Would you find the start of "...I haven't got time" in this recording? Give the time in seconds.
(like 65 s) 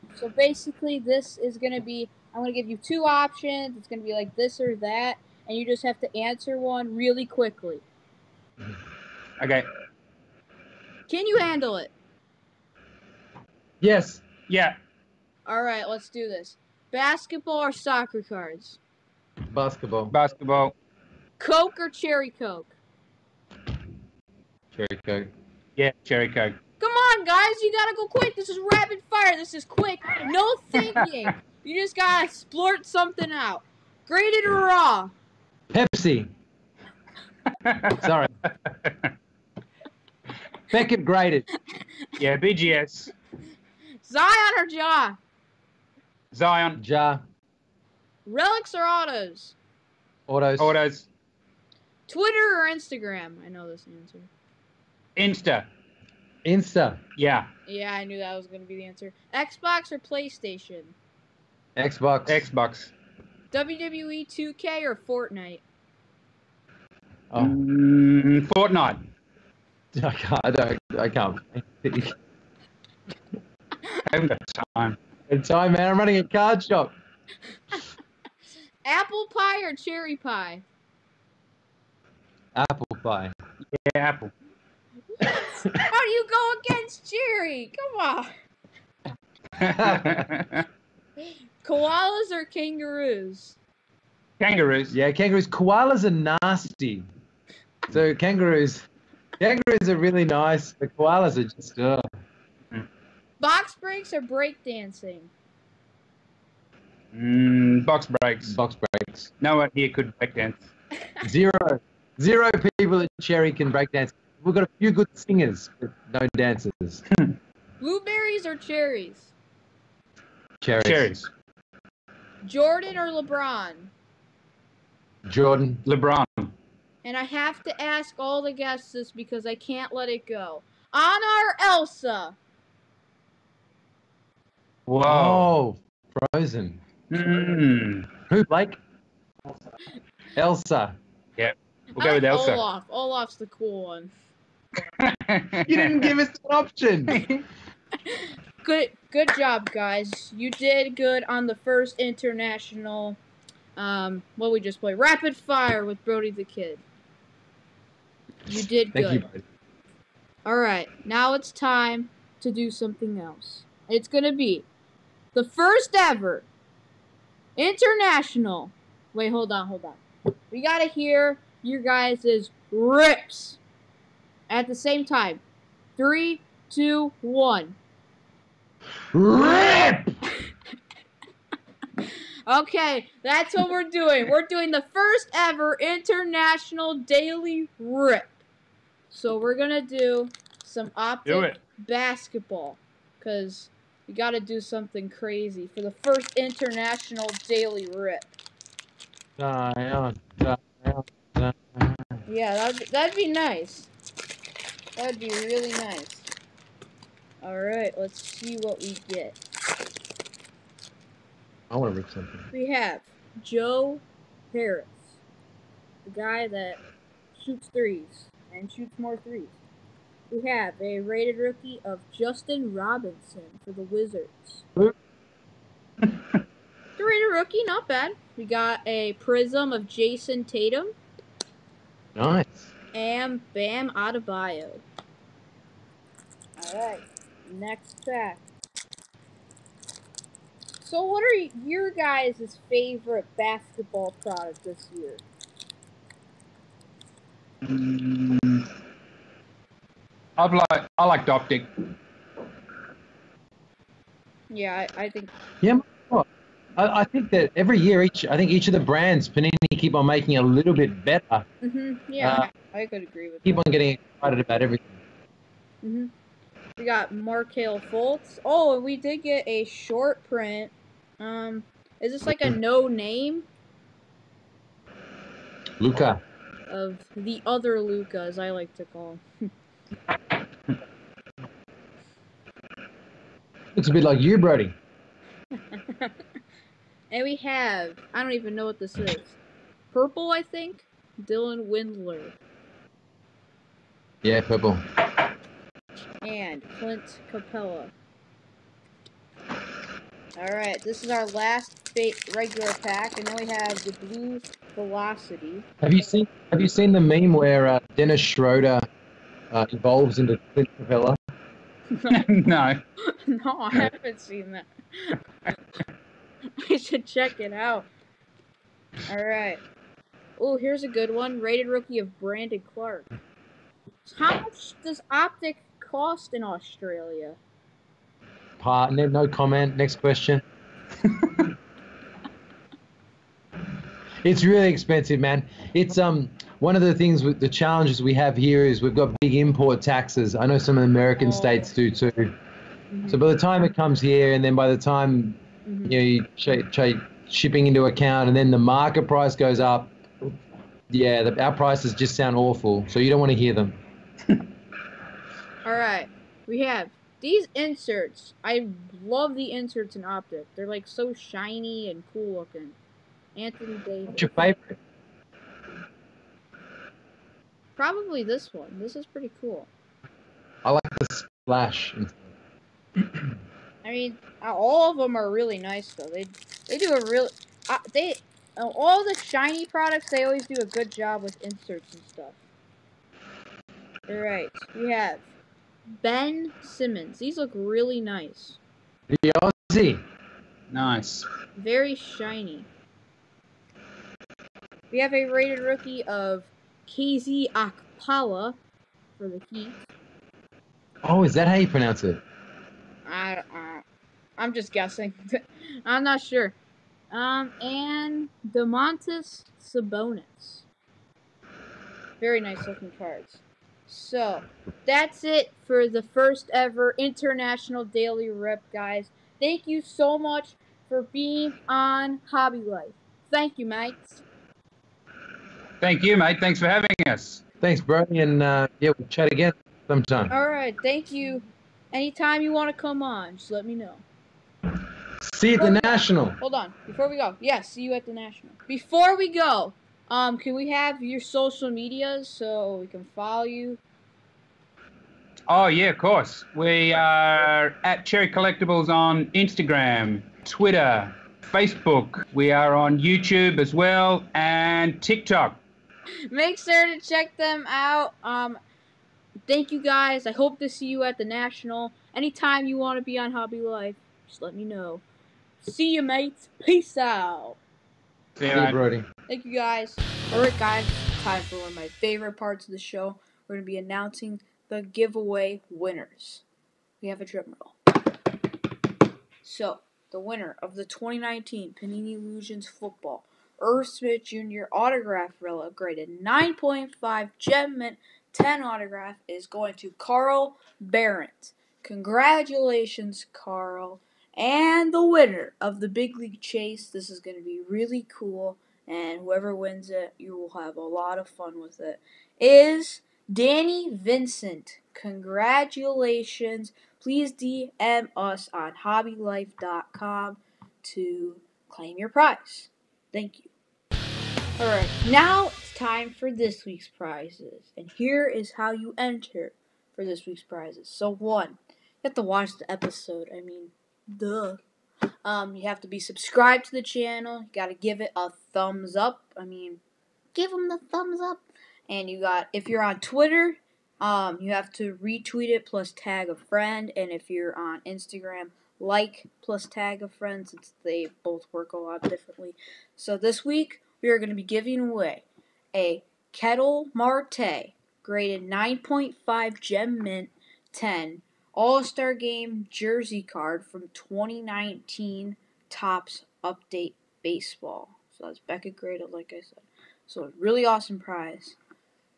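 73 s.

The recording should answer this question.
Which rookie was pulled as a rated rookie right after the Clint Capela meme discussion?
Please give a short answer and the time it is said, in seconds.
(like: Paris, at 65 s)
Brandon Clarke, at 322 s.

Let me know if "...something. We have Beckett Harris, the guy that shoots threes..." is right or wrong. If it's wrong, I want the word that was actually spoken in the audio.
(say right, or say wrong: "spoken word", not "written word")
wrong: "Joe", not "Beckett".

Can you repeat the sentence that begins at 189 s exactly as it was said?
So we're gonna do some optic do basketball, cause we gotta do something crazy for the first international daily rip.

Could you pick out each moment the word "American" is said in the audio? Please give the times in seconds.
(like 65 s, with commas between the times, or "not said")
340 s.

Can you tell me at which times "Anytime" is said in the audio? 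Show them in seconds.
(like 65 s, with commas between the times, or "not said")
431 s, 462 s.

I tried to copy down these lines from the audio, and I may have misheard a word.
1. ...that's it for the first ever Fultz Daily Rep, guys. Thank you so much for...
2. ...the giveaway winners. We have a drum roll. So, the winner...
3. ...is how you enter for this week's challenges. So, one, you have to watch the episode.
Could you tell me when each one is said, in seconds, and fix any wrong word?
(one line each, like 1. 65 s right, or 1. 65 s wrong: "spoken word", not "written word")
1. 414 s wrong: "International", not "Fultz"
2. 474 s right
3. 518 s wrong: "prizes", not "challenges".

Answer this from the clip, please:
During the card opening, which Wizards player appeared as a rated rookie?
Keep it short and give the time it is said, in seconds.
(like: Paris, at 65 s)
Justin Robinson, at 222 s.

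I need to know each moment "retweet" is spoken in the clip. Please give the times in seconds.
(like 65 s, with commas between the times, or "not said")
535 s.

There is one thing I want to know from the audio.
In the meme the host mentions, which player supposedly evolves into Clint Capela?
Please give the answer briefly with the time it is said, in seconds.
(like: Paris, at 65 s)
Dennis Schroeder, at 307 s.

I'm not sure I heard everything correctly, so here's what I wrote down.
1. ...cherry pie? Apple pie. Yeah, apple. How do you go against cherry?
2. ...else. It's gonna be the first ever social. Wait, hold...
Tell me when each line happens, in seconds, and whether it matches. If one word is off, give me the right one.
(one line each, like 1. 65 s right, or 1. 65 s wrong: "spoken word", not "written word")
1. 79 s right
2. 163 s wrong: "international", not "social".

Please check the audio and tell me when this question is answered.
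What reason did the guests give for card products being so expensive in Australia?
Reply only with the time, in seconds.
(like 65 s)
339 s.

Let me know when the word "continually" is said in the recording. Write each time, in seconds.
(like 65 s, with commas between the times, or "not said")
not said.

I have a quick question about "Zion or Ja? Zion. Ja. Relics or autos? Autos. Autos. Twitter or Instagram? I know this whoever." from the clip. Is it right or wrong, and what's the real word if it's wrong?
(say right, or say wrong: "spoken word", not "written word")
wrong: "answer", not "whoever".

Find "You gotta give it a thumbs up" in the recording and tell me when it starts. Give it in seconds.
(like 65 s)
527 s.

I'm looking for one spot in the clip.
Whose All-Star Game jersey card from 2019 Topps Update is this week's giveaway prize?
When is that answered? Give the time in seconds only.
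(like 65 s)
546 s.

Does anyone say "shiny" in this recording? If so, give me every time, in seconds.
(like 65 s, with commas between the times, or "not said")
361 s, 379 s, 391 s.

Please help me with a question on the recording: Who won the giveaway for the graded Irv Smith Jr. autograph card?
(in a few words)
Carl Barrett.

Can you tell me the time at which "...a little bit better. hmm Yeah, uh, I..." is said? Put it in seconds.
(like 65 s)
260 s.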